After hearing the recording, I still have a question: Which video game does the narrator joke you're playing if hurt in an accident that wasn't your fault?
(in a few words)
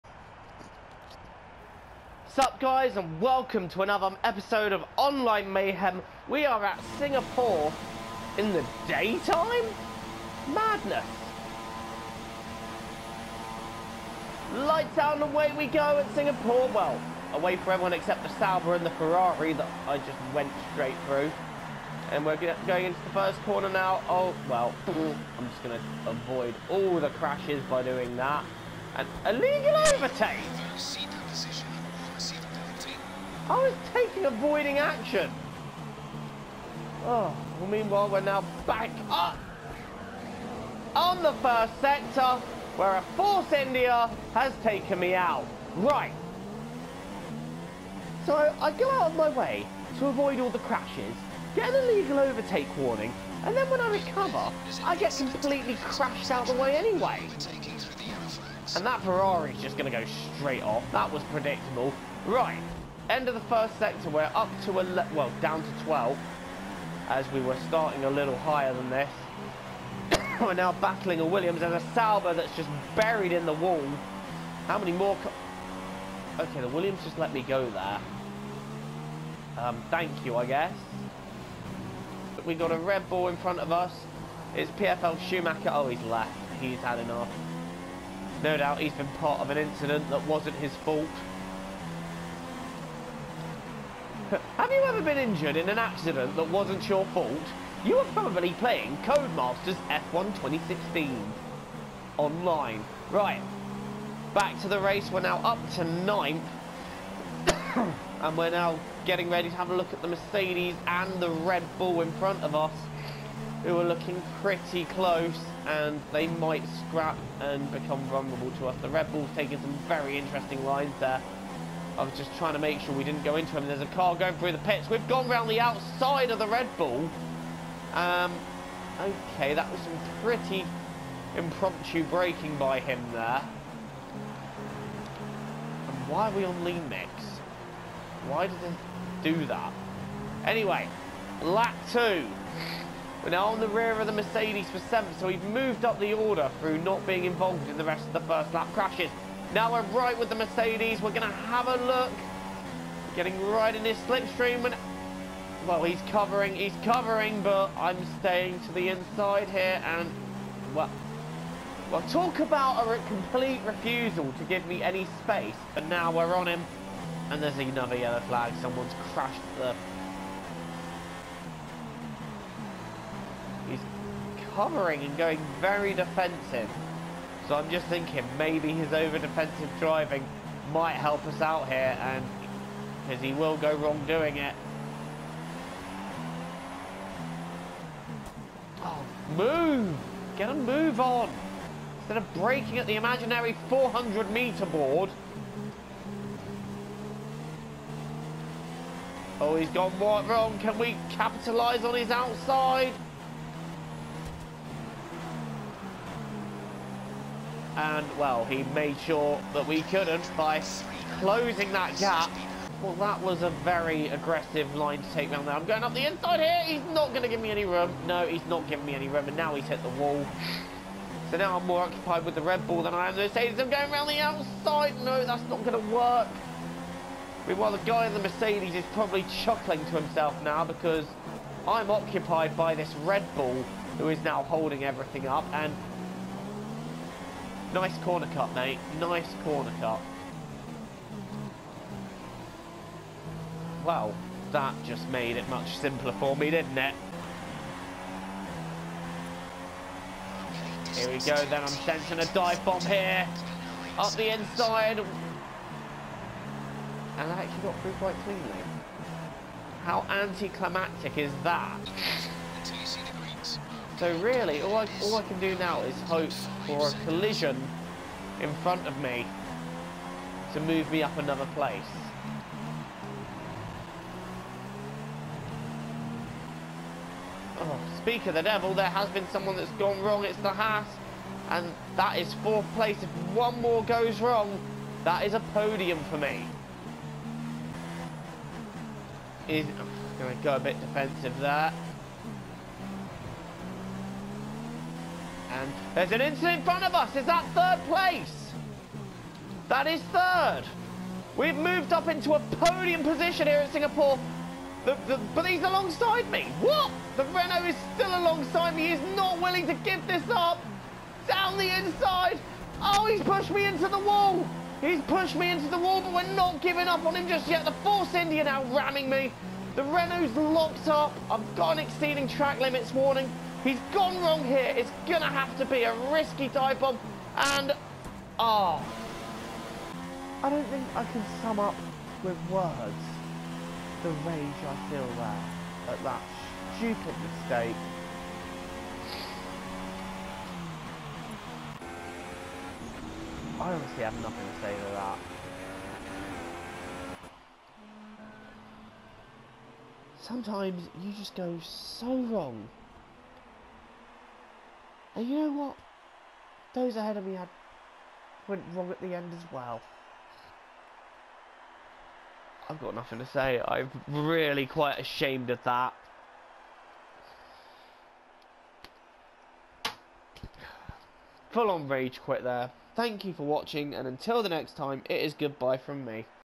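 Codemasters F1 2016.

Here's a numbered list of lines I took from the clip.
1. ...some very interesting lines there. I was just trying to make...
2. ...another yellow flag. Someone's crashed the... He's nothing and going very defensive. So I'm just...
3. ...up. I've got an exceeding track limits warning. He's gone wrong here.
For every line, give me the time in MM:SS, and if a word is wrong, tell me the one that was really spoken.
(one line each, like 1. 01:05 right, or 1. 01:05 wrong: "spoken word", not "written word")
1. 01:59 right
2. 02:47 wrong: "covering", not "nothing"
3. 05:20 right.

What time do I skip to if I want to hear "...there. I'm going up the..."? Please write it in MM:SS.
03:35.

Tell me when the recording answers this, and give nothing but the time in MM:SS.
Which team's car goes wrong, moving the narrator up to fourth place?
04:40.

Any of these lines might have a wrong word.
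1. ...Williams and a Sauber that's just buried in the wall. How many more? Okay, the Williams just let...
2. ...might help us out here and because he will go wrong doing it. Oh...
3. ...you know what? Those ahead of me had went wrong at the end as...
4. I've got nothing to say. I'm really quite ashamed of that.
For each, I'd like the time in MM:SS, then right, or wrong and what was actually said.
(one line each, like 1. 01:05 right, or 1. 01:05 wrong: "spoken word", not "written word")
1. 01:11 right
2. 03:00 right
3. 05:55 right
4. 06:02 right.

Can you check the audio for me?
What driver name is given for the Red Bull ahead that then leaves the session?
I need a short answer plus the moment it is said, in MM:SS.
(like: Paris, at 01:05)
PFL Schumacher, at 01:24.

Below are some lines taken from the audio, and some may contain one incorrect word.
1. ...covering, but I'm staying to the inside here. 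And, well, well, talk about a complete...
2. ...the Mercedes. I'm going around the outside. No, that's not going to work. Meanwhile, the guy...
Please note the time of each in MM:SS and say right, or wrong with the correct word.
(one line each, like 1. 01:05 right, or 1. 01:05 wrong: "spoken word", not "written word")
1. 02:36 right
2. 03:43 right.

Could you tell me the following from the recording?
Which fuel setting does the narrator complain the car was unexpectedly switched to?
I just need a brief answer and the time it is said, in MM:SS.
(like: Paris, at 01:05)
lean mix, at 02:16.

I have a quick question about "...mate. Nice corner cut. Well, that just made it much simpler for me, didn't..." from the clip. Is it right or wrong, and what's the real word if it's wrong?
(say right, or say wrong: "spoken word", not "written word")
right.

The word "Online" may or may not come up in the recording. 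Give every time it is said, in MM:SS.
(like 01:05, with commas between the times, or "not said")
00:04, 01:42.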